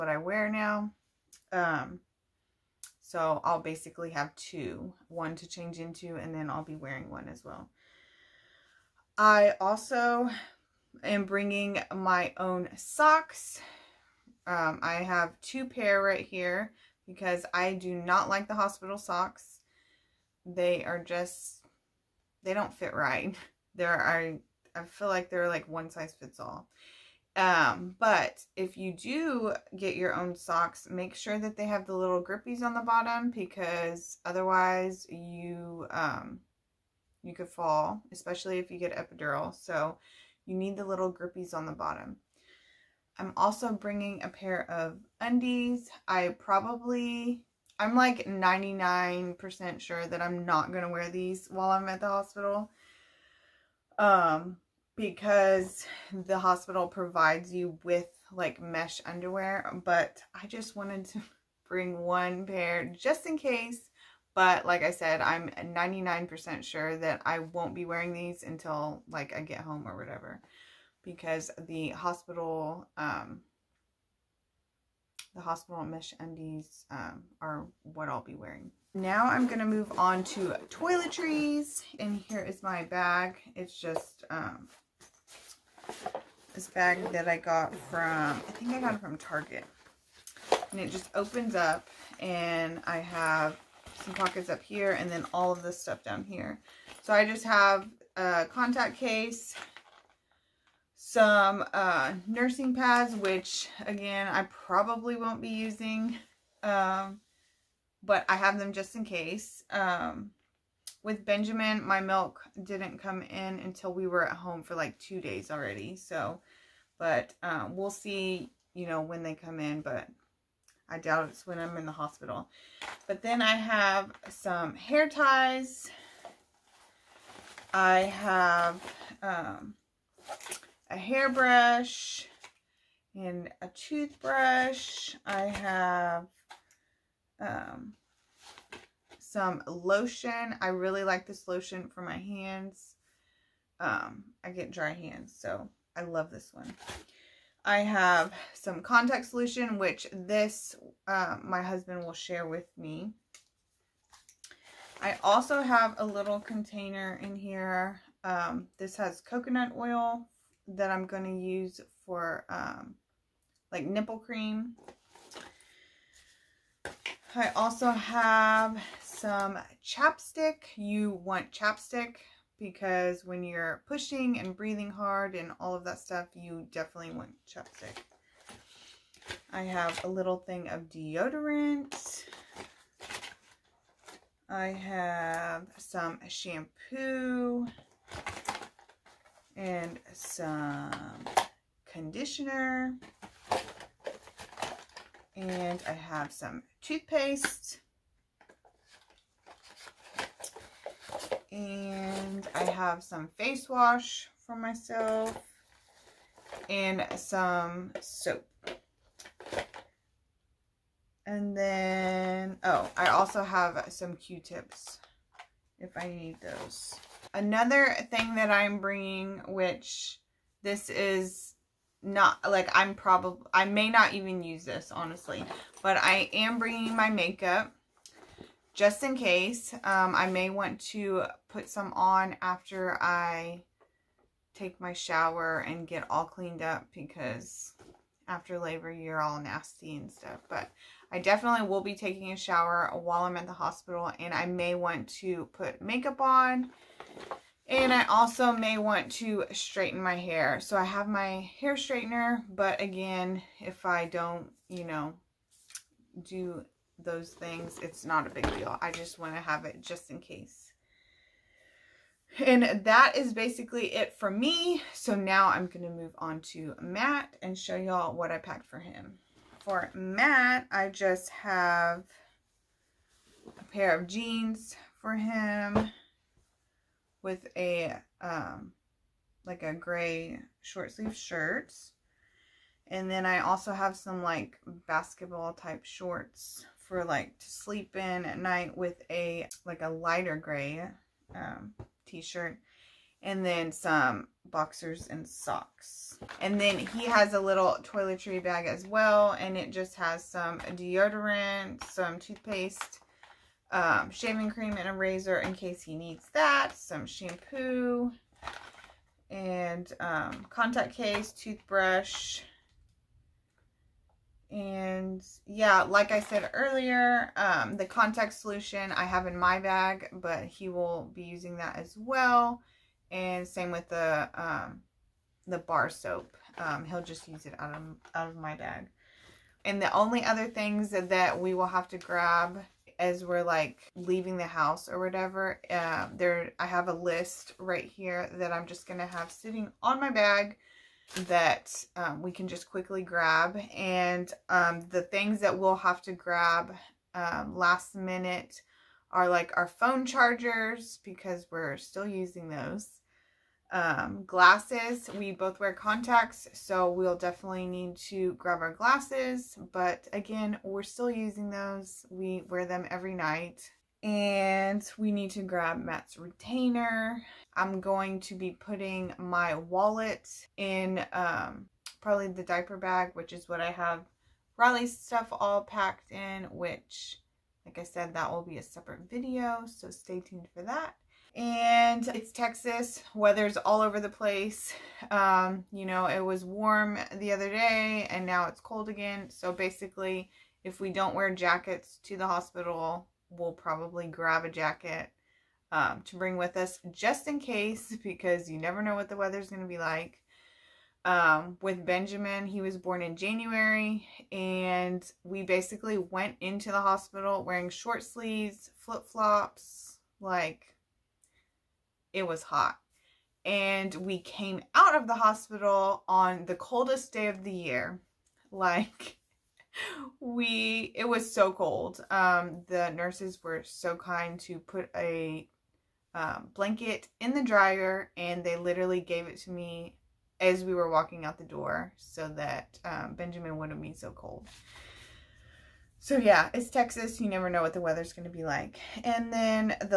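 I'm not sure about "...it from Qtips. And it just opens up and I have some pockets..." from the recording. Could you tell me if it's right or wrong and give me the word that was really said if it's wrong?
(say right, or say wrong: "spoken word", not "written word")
wrong: "Target", not "Qtips".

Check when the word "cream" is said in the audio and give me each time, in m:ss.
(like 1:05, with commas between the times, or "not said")
2:44, 5:04.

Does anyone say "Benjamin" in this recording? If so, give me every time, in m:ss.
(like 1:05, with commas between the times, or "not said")
1:51, 6:41, 7:13.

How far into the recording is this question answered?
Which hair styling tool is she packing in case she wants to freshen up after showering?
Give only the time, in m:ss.
4:11.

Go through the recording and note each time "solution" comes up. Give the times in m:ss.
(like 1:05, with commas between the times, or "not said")
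2:29, 5:18.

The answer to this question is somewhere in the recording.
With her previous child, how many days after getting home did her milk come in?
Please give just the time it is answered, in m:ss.
1:54.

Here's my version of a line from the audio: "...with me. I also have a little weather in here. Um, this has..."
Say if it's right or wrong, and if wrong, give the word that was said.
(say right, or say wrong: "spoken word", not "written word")
wrong: "container", not "weather".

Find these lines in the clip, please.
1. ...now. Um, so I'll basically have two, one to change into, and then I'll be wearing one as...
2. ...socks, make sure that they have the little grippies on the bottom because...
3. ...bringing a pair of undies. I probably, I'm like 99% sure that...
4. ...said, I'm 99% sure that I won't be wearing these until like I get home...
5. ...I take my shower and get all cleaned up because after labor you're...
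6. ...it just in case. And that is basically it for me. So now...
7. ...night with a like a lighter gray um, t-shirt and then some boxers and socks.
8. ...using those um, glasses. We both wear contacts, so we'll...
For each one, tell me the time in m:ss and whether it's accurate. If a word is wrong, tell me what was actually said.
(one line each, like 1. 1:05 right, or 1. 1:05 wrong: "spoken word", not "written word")
1. 0:00 right
2. 0:30 right
3. 0:43 right
4. 1:04 right
5. 3:53 right
6. 4:19 right
7. 4:48 right
8. 5:52 right.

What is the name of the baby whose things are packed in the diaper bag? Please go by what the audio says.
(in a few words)
Riley.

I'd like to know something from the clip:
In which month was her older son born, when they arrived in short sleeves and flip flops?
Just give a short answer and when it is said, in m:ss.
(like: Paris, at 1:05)
January, at 6:43.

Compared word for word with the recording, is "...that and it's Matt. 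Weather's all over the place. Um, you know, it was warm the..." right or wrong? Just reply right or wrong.
wrong.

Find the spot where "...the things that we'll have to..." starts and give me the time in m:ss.
5:44.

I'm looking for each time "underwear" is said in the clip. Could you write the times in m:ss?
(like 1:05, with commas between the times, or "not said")
0:59.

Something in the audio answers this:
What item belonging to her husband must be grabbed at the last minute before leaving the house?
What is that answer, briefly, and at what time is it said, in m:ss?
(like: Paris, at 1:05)
Retainer, at 6:06.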